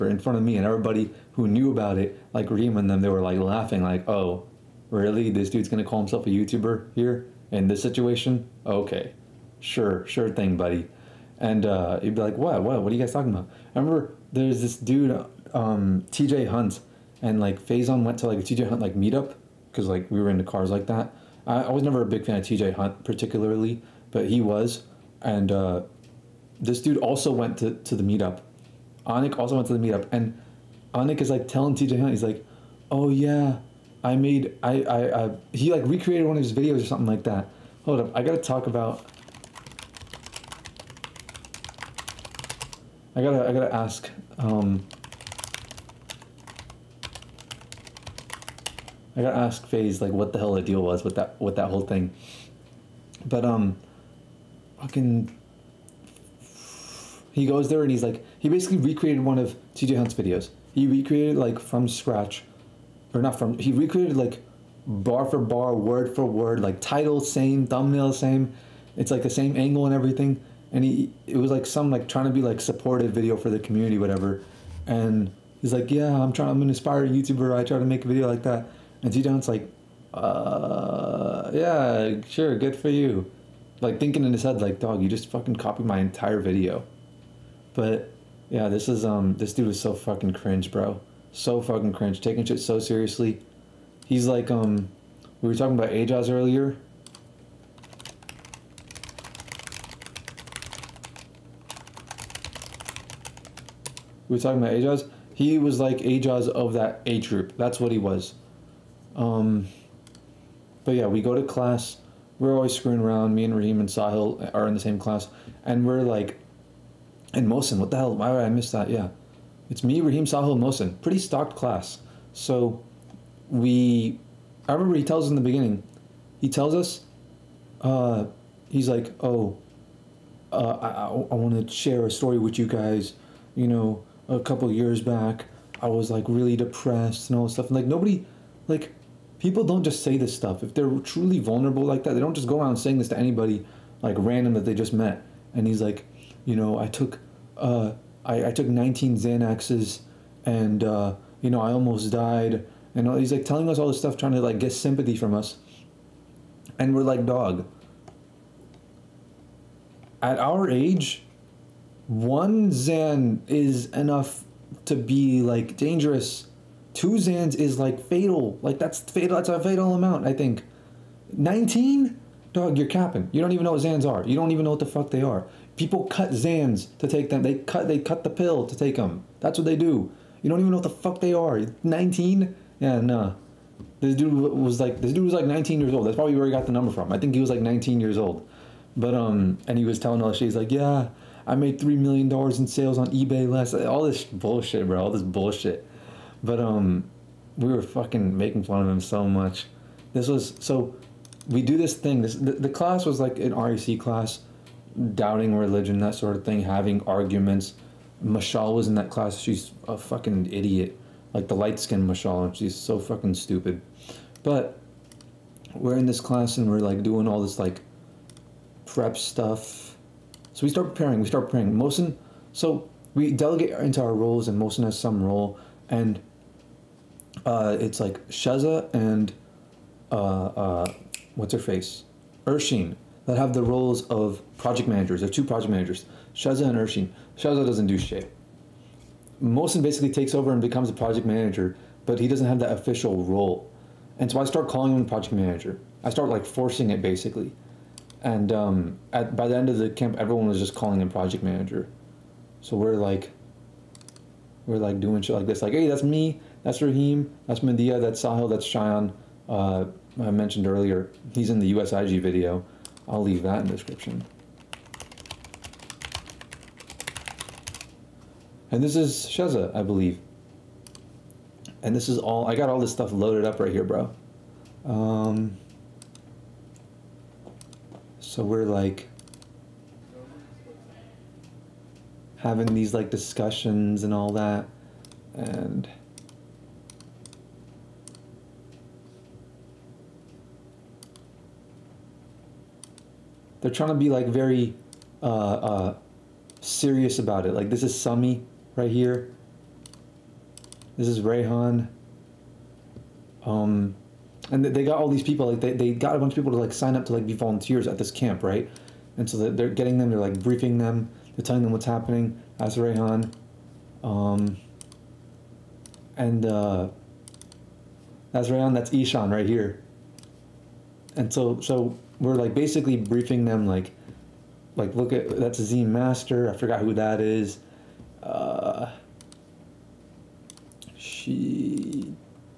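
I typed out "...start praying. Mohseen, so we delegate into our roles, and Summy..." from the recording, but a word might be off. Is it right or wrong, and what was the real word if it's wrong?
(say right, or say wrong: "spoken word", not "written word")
wrong: "Mohseen", not "Summy".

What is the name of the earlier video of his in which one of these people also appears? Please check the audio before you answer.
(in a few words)
USIG video.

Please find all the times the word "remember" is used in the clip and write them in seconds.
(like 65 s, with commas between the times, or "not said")
13 s, 124 s.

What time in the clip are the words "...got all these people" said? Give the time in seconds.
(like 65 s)
304 s.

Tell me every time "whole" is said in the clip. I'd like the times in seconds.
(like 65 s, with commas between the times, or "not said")
51 s.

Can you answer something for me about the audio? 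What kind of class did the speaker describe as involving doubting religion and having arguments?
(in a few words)
REC class.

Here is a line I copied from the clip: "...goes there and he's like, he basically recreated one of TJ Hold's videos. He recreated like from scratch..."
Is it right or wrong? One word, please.
wrong.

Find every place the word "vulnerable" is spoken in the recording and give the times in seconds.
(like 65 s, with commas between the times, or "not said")
141 s.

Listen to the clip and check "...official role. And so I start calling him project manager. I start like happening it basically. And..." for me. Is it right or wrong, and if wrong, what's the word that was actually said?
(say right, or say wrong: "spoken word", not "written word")
wrong: "forcing", not "happening".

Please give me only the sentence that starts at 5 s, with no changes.
This dude's gonna call himself a YouTuber here in this situation?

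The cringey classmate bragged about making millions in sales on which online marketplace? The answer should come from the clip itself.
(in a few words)
eBay.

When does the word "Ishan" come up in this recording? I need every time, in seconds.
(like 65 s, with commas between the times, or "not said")
318 s.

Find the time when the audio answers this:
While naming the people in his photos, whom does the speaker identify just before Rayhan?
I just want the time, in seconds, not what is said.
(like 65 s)
297 s.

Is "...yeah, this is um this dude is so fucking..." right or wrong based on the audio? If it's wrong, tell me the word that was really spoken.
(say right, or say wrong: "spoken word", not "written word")
right.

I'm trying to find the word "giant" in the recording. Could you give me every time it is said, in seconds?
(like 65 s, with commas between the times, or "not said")
not said.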